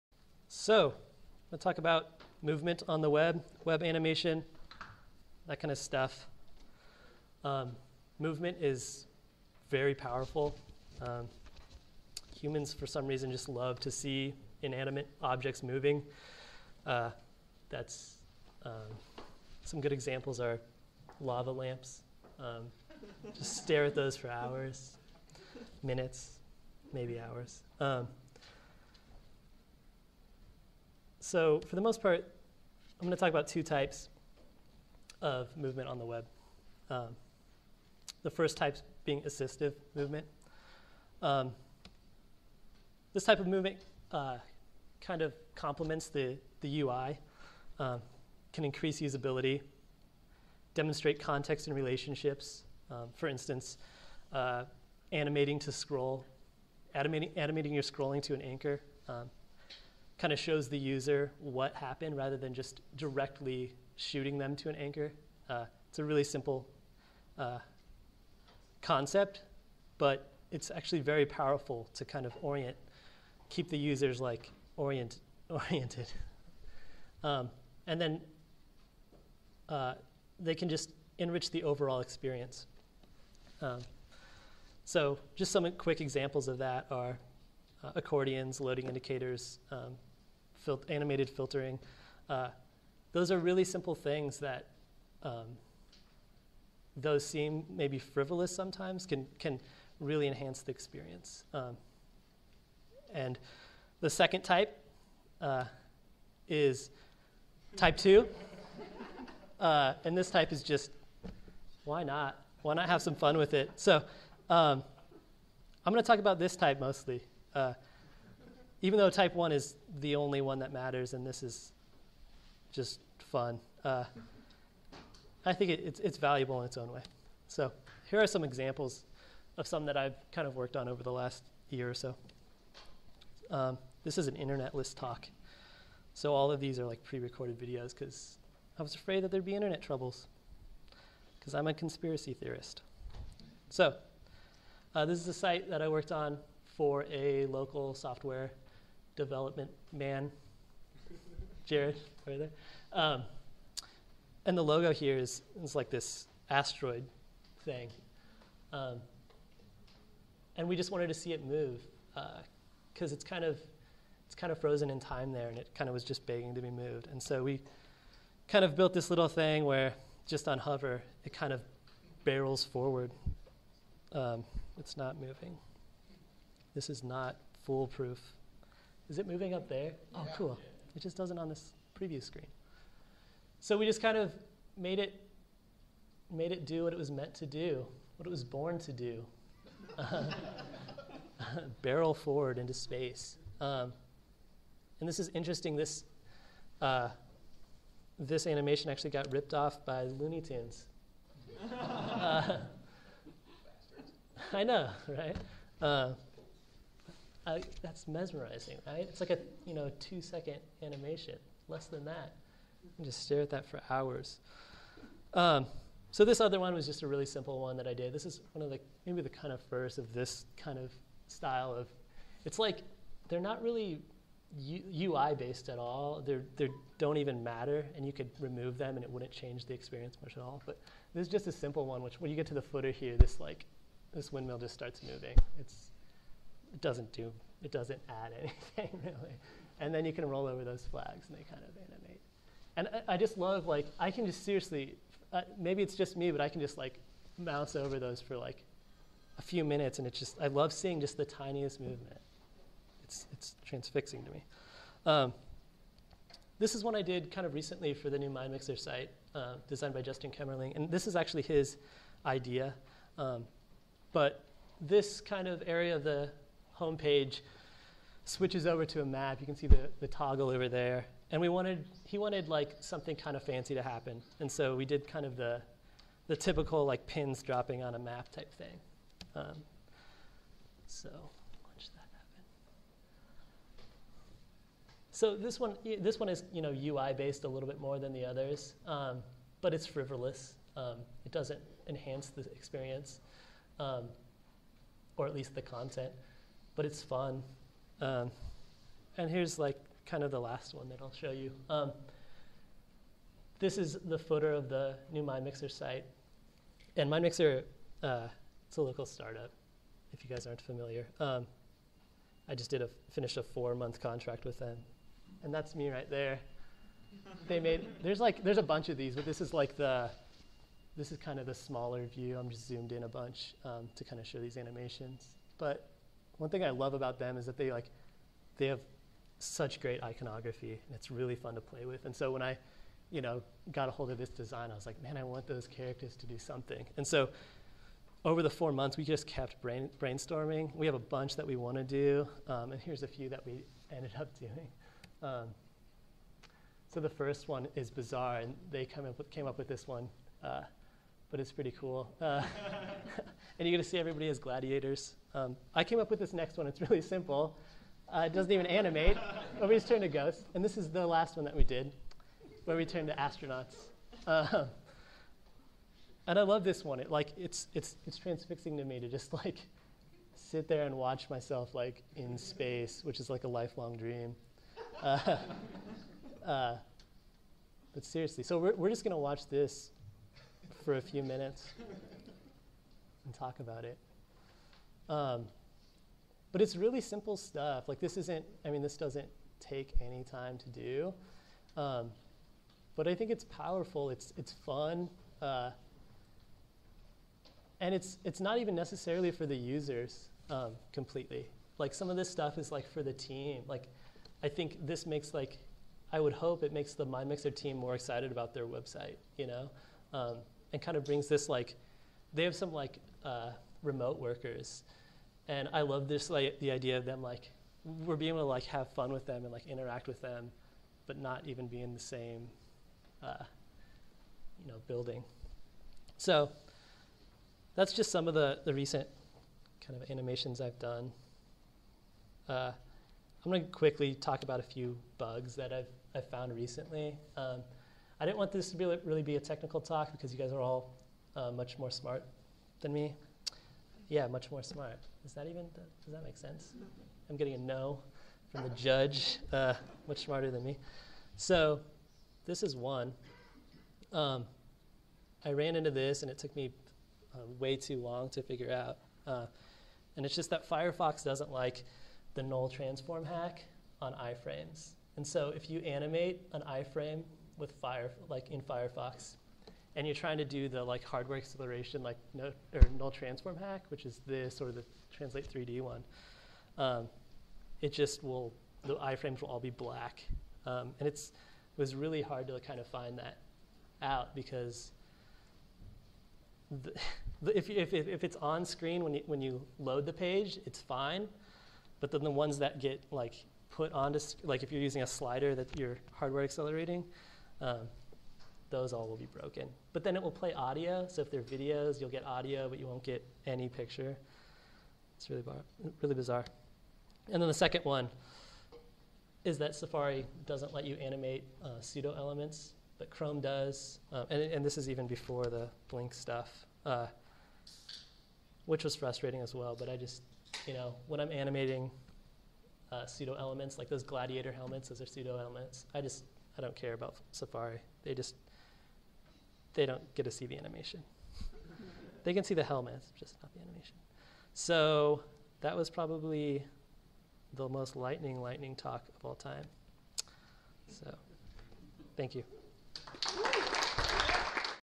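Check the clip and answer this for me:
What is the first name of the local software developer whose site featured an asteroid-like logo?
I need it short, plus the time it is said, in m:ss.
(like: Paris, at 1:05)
Jared, at 2:31.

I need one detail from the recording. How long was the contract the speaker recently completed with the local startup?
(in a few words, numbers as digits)
Four months.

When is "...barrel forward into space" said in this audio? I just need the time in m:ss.
3:11.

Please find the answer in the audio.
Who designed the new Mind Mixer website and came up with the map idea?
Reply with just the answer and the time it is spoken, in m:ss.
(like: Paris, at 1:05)
Justin Kemmerling, at 4:20.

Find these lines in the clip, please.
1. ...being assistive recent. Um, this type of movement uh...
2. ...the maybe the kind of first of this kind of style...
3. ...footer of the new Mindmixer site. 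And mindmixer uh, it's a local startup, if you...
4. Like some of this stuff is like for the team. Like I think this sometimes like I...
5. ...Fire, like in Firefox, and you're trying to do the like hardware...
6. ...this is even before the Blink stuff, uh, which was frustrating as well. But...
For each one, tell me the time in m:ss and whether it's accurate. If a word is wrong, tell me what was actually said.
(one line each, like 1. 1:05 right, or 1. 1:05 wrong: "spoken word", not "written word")
1. 0:39 wrong: "movement", not "recent"
2. 3:38 right
3. 5:04 right
4. 6:41 wrong: "makes", not "sometimes"
5. 7:47 right
6. 8:34 right.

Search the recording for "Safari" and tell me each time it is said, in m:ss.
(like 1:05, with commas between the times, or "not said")
8:29, 8:47.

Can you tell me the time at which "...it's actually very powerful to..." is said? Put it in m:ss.
1:10.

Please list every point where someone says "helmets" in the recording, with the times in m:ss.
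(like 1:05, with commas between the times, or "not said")
8:44, 8:52.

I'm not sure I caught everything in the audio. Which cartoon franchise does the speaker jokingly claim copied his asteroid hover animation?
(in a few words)
Looney Tunes.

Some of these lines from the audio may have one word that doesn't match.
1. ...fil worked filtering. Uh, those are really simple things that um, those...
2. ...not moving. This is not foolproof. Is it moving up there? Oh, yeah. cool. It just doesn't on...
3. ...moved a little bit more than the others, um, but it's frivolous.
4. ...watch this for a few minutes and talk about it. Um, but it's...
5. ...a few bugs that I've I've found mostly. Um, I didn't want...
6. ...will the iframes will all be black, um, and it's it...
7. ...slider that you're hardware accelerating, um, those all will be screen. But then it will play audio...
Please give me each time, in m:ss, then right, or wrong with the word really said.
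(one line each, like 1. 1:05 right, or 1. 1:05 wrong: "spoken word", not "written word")
1. 1:30 wrong: "animated", not "worked"
2. 2:54 right
3. 4:47 wrong: "based", not "moved"
4. 6:19 right
5. 7:14 wrong: "recently", not "mostly"
6. 7:58 right
7. 8:15 wrong: "broken", not "screen".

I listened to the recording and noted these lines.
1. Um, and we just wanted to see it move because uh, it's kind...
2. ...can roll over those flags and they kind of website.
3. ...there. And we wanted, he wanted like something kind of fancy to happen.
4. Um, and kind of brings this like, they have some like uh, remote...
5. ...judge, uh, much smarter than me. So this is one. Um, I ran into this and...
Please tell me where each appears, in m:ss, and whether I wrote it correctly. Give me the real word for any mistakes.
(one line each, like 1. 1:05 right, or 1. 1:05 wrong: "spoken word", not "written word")
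1. 2:38 right
2. 4:00 wrong: "animate", not "website"
3. 4:30 right
4. 6:50 right
5. 7:28 right.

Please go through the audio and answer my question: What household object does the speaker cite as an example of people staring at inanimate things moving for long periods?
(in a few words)
Lava lamps.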